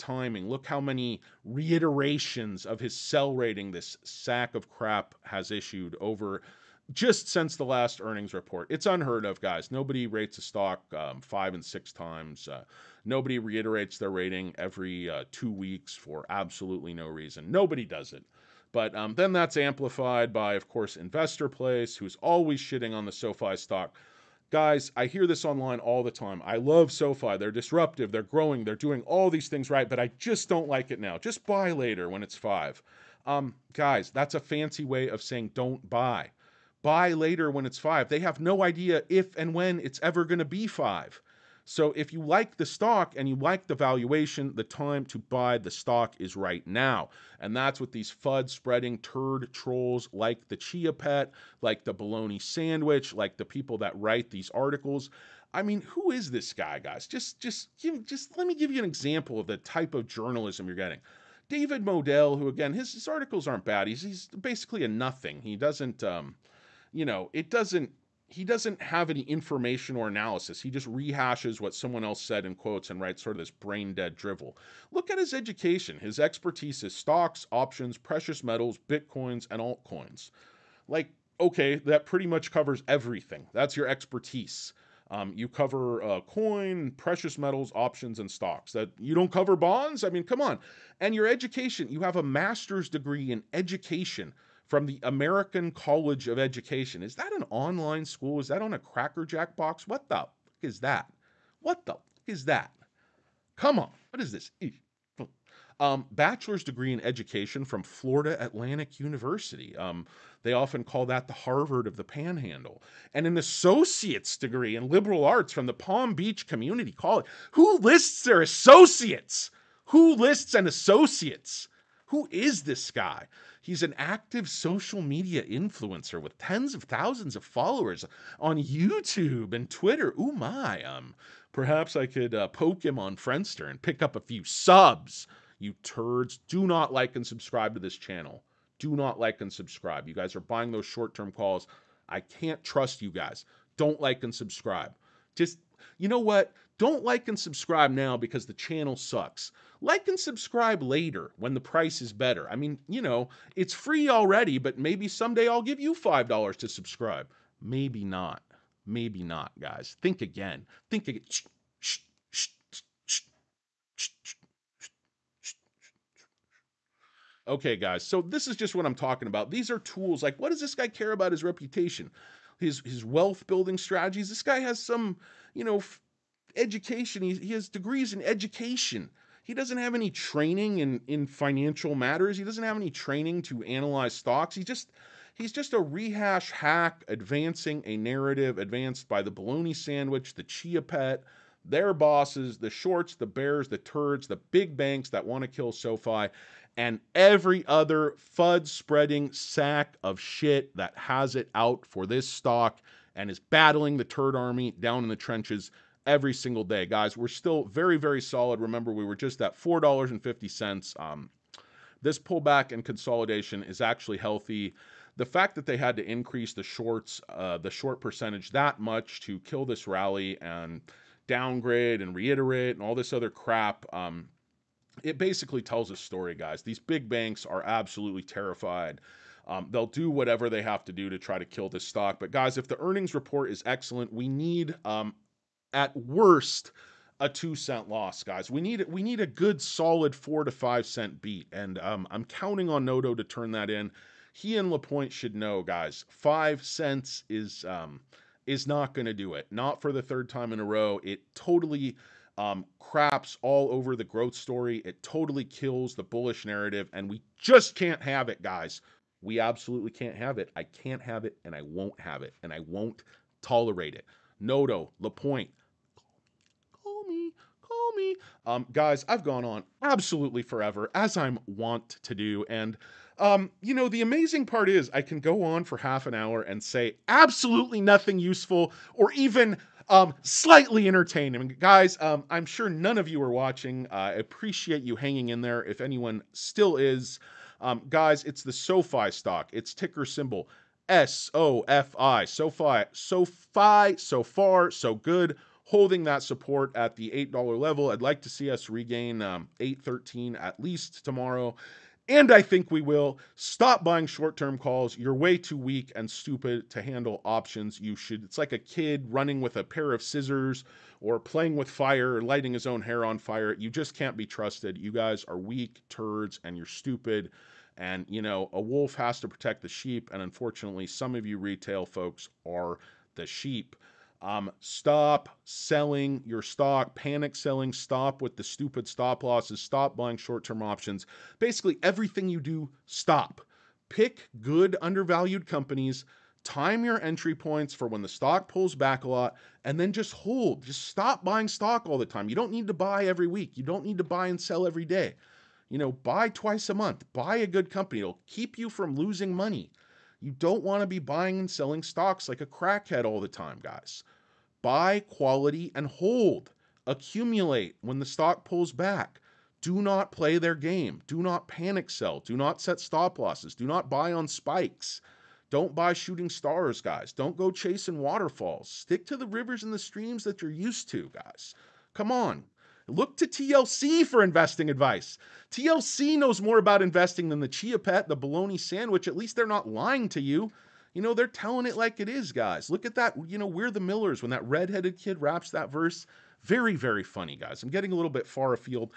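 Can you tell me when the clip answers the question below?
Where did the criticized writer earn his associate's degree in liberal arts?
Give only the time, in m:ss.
1:55.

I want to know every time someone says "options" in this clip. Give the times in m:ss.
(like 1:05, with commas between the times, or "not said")
1:17, 1:27, 5:07, 5:30.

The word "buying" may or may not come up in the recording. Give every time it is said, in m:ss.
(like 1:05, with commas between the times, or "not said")
2:20, 5:03, 5:29, 5:41, 5:50.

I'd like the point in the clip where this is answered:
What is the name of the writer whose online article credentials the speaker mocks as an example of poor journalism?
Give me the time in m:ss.
1:01.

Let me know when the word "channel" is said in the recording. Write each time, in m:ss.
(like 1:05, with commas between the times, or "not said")
2:17, 2:28.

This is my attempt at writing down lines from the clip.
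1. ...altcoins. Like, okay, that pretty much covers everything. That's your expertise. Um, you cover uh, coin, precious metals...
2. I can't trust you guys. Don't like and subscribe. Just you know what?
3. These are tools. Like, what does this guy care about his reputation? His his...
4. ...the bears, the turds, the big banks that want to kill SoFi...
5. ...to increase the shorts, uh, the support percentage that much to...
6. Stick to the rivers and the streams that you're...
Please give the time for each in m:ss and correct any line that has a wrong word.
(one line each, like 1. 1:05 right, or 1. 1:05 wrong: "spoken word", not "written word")
1. 1:19 right
2. 2:22 right
3. 2:49 right
4. 3:13 right
5. 3:35 wrong: "short", not "support"
6. 6:08 right.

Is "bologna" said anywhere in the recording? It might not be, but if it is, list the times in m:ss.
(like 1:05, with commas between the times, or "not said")
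0:51, 3:09, 6:18.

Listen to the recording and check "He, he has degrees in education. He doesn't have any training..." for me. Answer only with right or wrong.
right.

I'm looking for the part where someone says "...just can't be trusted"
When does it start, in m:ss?
5:13.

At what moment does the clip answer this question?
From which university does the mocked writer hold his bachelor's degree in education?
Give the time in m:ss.
1:47.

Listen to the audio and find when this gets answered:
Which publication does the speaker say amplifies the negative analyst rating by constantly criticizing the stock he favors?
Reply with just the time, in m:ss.
0:20.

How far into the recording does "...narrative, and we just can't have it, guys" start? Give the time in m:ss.
4:16.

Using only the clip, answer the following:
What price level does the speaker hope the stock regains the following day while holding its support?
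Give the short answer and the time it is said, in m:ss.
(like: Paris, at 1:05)
813, at 4:59.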